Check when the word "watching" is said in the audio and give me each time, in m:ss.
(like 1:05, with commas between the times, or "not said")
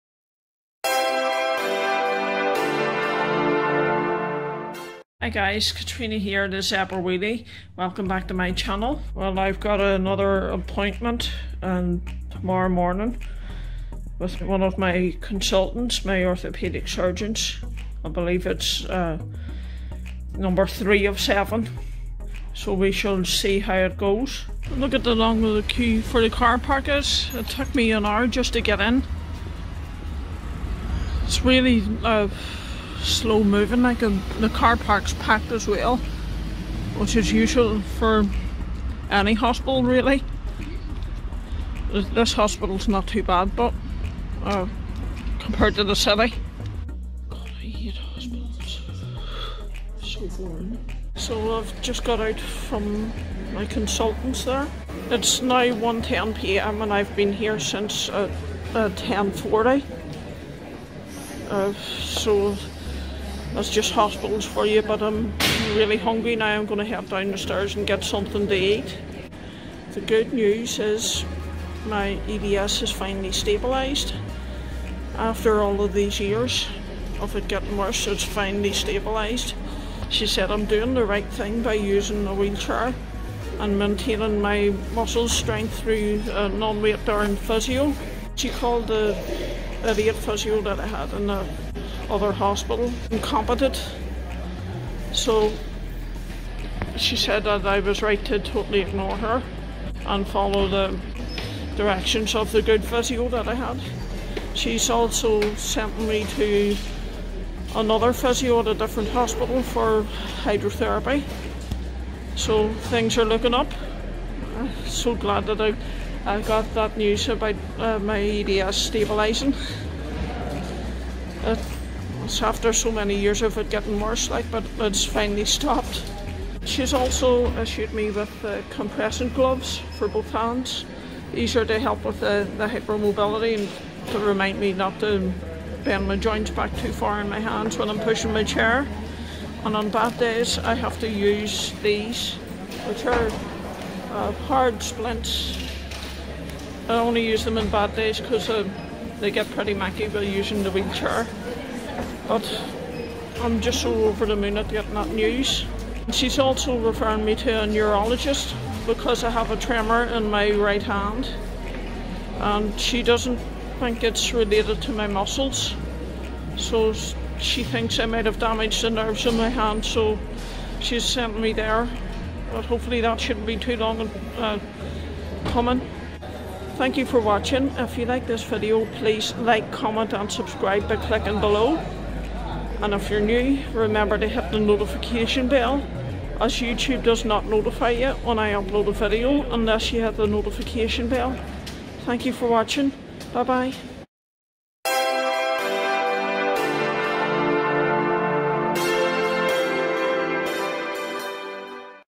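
2:57, 3:12.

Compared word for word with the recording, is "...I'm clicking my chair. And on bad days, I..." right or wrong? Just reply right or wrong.
wrong.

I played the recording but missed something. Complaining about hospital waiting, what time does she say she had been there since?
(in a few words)
10:40.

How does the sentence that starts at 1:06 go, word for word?
I'm going to head down the stairs and get something to eat.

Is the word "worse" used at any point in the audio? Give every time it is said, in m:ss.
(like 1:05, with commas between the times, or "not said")
1:17, 2:03.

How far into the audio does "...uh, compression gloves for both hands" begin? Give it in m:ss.
2:08.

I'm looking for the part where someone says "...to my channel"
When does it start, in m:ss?
0:08.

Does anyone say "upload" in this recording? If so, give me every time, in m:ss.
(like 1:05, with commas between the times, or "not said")
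3:08.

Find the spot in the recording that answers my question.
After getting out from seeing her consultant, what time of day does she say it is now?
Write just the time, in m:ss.
0:55.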